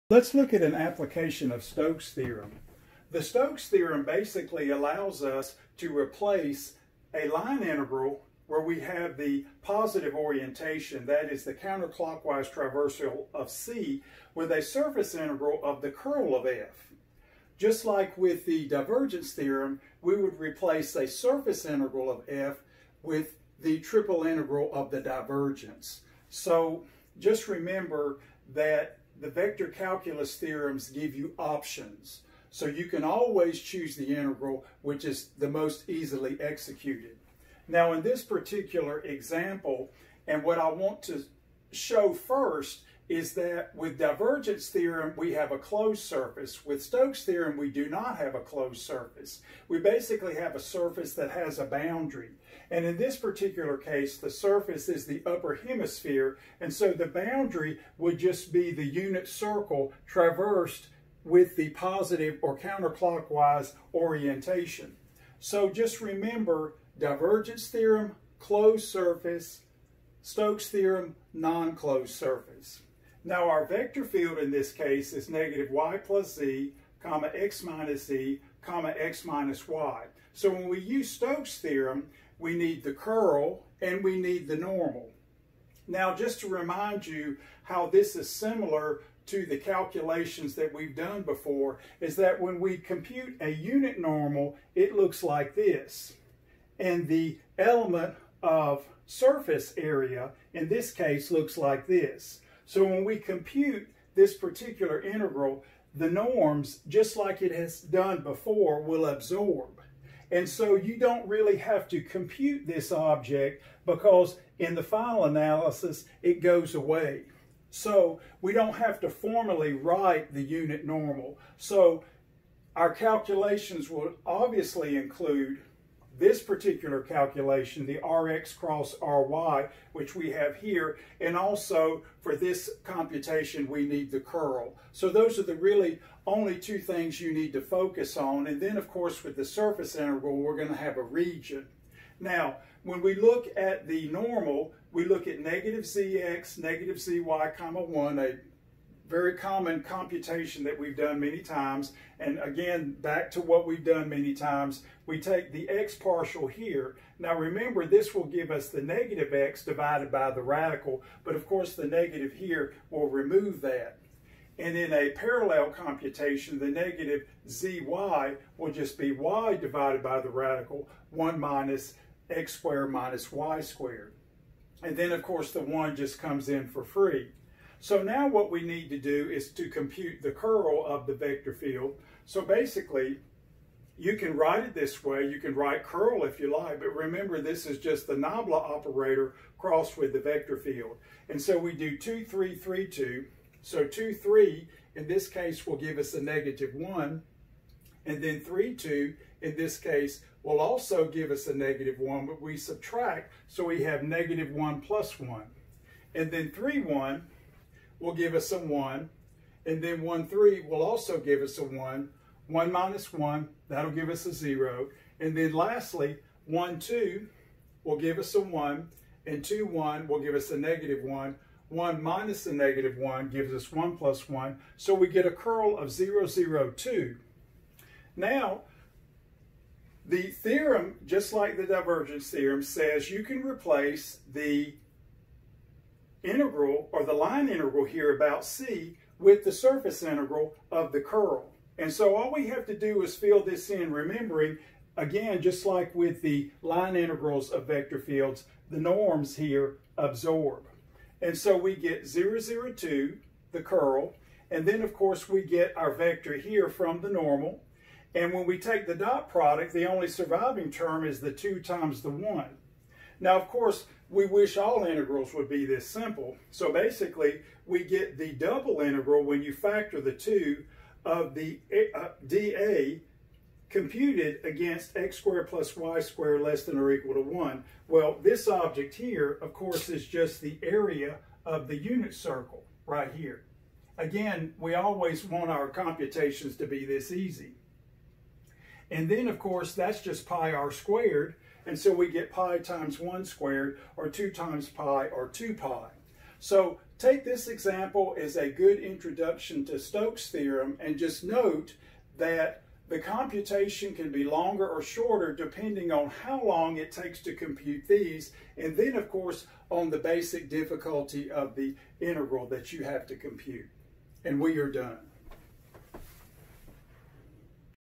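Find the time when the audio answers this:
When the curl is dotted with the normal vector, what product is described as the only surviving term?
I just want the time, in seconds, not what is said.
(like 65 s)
261 s.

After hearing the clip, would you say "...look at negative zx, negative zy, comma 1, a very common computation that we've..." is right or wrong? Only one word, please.
right.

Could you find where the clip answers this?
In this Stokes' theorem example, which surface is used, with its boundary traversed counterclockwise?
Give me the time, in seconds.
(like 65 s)
55 s.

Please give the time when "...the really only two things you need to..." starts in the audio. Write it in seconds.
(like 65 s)
135 s.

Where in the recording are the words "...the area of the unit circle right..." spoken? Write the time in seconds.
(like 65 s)
280 s.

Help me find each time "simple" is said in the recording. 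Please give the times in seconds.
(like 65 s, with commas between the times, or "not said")
265 s.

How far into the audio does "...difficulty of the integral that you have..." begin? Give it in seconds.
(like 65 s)
310 s.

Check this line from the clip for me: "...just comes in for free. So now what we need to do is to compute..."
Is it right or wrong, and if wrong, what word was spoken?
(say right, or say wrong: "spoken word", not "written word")
right.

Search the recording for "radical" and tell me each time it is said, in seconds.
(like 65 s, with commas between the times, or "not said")
160 s, 170 s.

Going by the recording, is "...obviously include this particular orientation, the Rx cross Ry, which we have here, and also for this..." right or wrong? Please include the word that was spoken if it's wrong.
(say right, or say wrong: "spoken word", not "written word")
wrong: "calculation", not "orientation".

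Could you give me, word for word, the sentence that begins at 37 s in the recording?
Now in this particular example, and what I want to show first is that with divergence theorem, we have a closed surface.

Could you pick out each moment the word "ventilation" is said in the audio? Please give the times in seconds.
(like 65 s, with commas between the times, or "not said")
not said.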